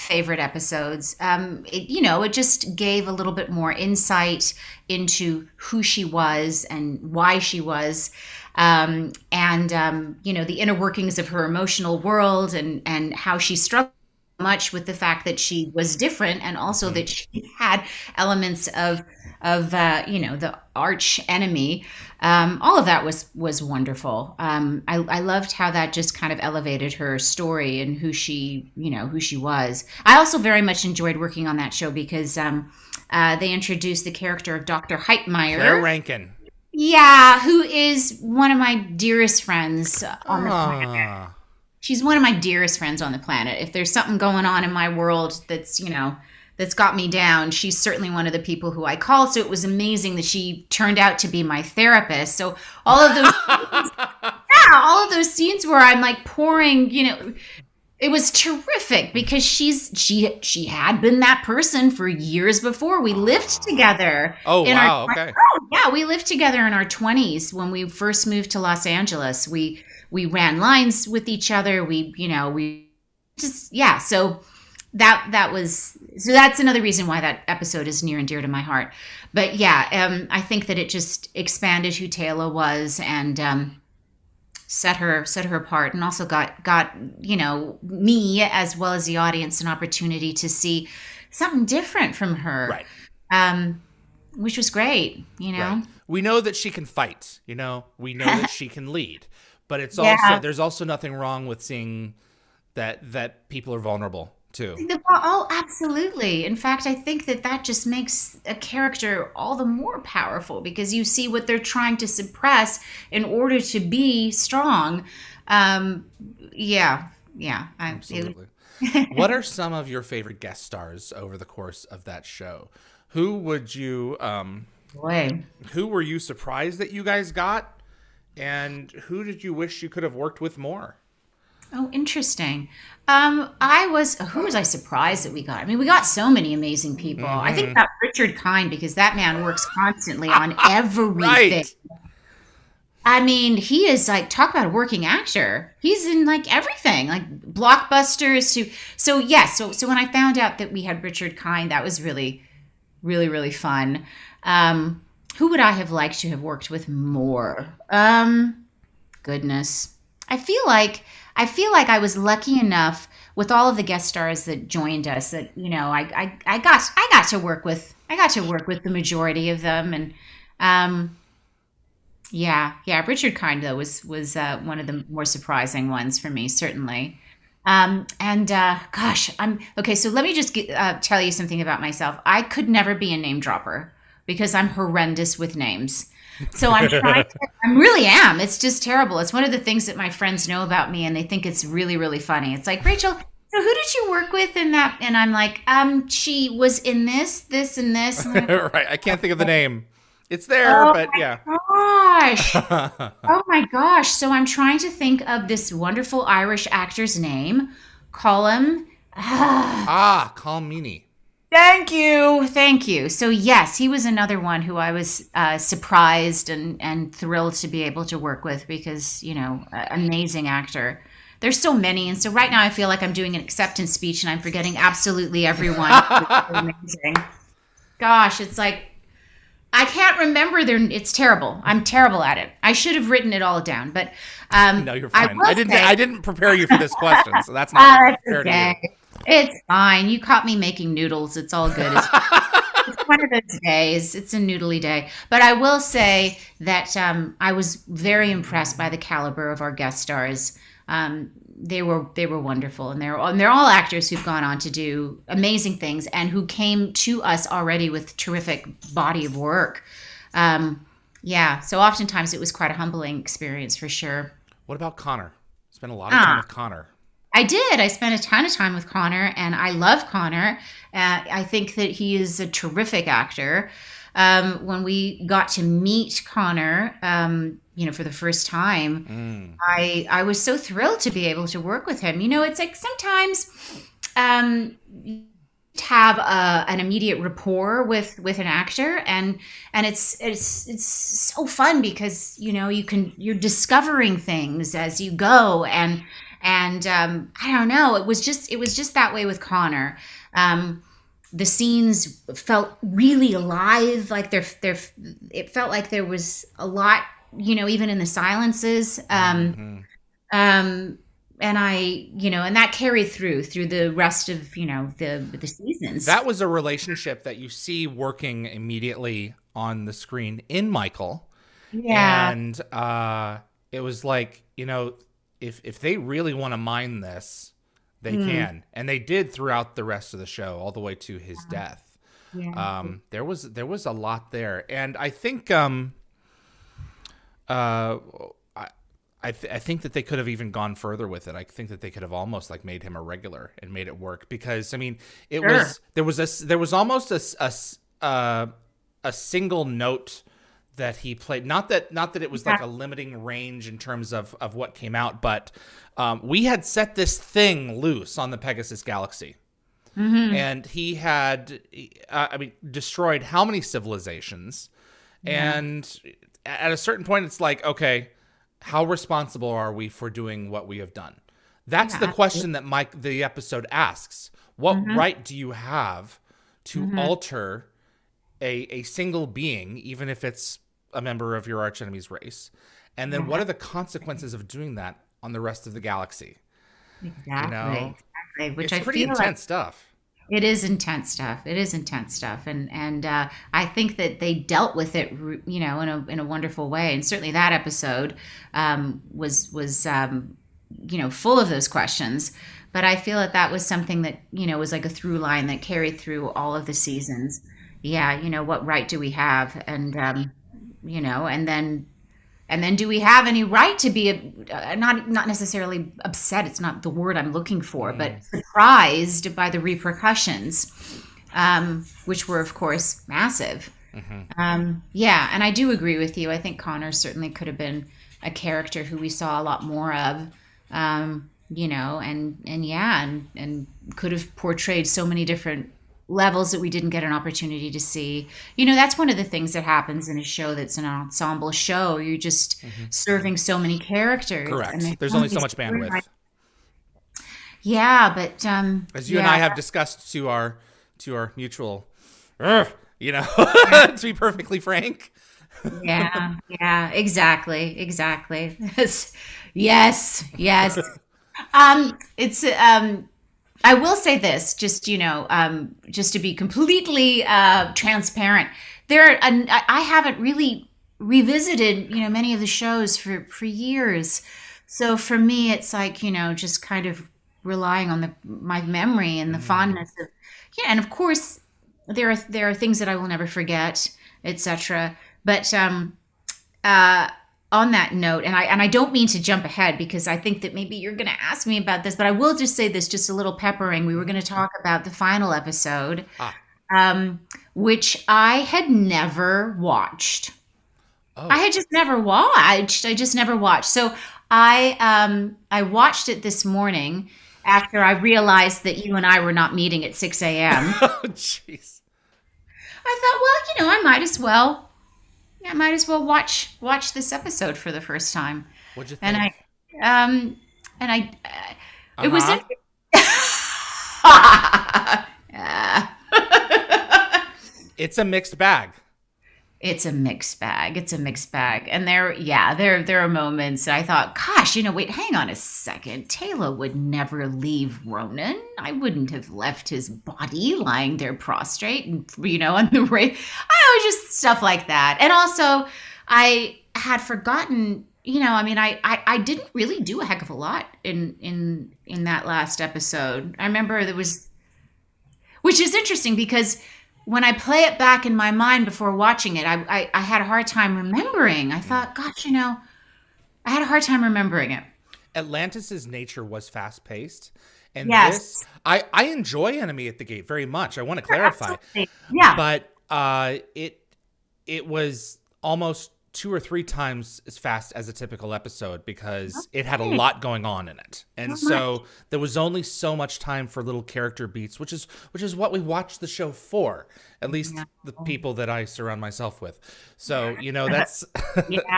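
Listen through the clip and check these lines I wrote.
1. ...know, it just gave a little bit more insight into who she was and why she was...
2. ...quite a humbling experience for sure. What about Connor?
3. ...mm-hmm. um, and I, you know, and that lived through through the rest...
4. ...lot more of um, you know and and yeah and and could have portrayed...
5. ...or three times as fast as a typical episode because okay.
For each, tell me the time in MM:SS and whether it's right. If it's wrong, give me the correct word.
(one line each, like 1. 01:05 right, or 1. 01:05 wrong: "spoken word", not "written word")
1. 00:02 right
2. 04:22 right
3. 05:09 wrong: "carried", not "lived"
4. 07:09 right
5. 09:36 right.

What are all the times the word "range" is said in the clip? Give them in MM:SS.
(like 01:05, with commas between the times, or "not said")
05:53.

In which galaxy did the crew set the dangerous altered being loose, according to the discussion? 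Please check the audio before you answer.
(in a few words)
Pegasus Galaxy.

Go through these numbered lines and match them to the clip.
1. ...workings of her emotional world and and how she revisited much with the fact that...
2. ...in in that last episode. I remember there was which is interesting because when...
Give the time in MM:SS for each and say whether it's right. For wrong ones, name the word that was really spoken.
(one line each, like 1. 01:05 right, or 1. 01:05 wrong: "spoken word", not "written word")
1. 00:10 wrong: "struggled", not "revisited"
2. 09:11 right.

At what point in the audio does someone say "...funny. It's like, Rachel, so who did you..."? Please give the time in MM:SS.
03:12.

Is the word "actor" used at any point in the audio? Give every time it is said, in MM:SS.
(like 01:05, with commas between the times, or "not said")
02:25, 03:26, 03:40, 04:13, 04:33, 04:48.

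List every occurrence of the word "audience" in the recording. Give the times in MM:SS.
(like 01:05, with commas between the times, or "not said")
01:29.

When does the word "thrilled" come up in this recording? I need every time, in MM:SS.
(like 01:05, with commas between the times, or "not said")
03:37, 04:40.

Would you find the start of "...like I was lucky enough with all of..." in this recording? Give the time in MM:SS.
02:41.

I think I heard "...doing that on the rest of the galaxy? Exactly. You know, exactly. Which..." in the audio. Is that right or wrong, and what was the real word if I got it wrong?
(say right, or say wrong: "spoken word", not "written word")
right.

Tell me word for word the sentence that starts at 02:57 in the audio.
Um, and uh, gosh, I'm okay.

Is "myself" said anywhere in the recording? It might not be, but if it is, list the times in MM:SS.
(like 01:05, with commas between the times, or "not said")
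03:01, 09:49.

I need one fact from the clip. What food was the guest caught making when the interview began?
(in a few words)
noodles.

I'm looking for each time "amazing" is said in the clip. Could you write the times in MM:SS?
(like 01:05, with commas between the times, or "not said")
00:49, 02:16, 03:39, 03:46, 04:15.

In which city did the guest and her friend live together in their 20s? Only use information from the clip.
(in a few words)
Los Angeles.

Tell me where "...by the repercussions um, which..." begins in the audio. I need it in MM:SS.
06:59.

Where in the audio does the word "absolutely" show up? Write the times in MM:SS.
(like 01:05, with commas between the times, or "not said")
01:45, 01:57, 03:44, 09:31.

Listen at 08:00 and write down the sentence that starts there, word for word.
And of course, there are there are things that I will never forget, etc.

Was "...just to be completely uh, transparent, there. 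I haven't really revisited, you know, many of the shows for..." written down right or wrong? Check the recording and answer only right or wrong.
right.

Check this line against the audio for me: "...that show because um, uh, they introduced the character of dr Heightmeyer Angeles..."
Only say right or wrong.
wrong.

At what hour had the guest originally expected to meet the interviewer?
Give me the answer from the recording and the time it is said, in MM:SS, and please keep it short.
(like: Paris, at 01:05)
6 a.m., at 08:29.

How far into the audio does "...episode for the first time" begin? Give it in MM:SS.
08:37.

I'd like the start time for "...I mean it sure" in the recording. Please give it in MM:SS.
05:44.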